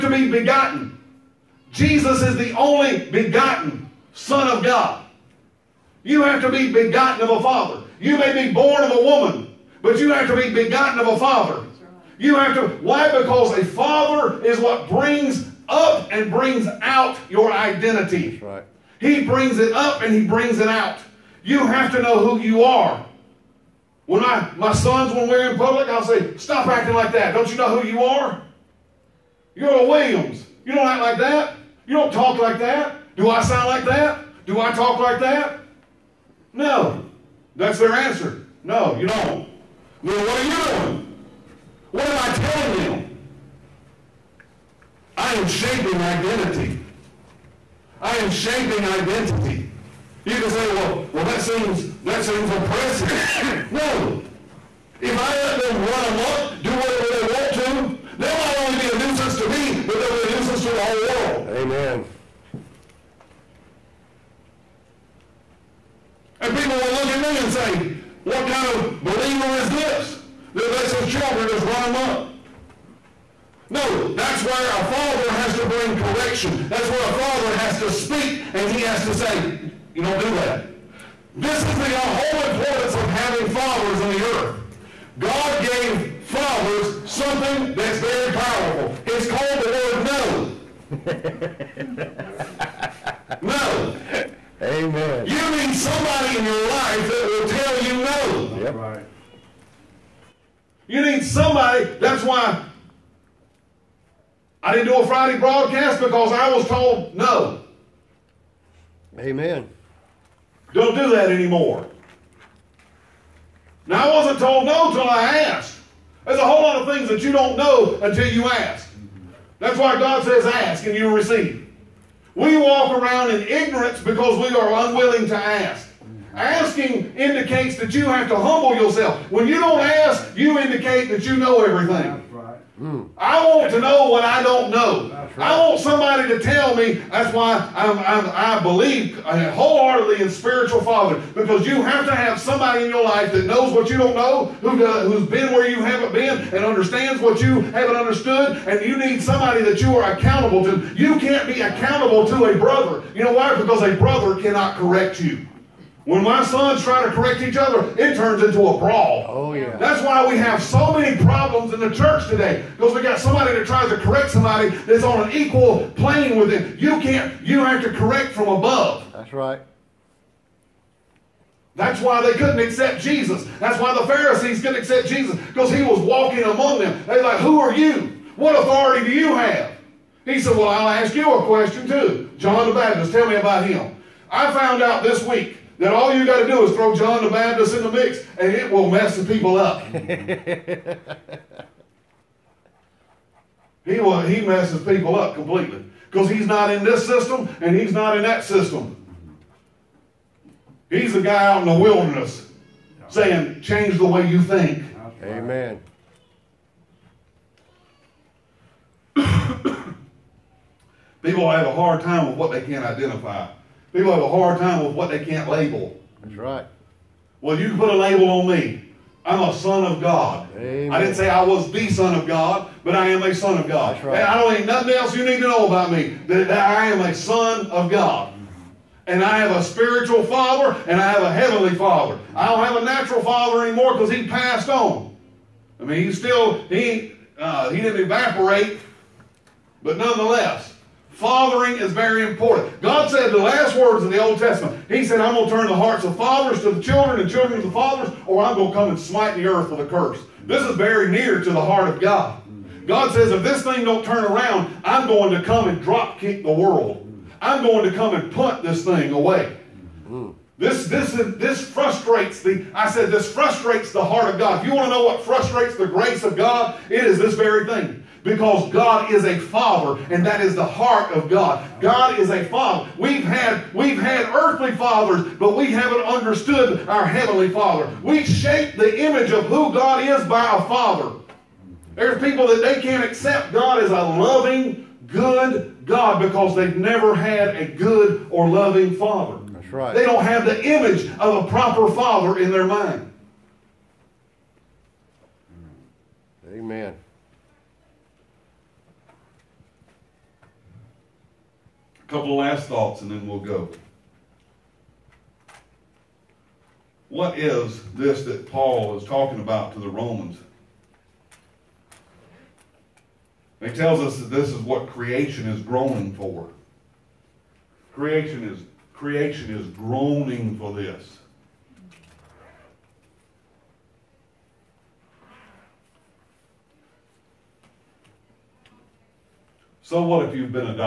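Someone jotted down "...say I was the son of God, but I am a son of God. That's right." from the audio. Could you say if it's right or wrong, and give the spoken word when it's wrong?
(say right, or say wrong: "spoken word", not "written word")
right.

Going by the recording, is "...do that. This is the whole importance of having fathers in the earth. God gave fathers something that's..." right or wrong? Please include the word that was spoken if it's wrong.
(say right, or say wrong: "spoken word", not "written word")
right.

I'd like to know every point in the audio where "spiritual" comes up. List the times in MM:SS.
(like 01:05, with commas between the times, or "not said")
02:20, 03:49.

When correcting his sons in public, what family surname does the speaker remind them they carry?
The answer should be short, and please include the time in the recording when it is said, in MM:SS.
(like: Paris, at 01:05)
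Williams, at 00:29.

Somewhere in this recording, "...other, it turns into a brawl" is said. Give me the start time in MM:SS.
02:37.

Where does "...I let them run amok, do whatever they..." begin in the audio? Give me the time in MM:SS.
00:55.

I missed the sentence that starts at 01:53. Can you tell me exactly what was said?
Now, I wasn't told no until I asked.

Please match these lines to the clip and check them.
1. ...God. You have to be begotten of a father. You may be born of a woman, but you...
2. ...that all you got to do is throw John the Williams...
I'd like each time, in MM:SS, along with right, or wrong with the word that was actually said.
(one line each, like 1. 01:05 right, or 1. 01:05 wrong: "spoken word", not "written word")
1. 00:04 right
2. 03:05 wrong: "Baptist", not "Williams".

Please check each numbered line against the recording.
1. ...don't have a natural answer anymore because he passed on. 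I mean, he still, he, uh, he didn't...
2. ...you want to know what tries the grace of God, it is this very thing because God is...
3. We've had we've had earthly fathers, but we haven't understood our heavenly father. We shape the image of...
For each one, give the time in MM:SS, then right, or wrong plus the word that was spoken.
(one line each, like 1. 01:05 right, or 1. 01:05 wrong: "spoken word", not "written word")
1. 03:52 wrong: "father", not "answer"
2. 04:24 wrong: "frustrates", not "tries"
3. 04:32 right.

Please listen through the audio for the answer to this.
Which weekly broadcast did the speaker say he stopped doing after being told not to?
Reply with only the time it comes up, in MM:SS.
01:45.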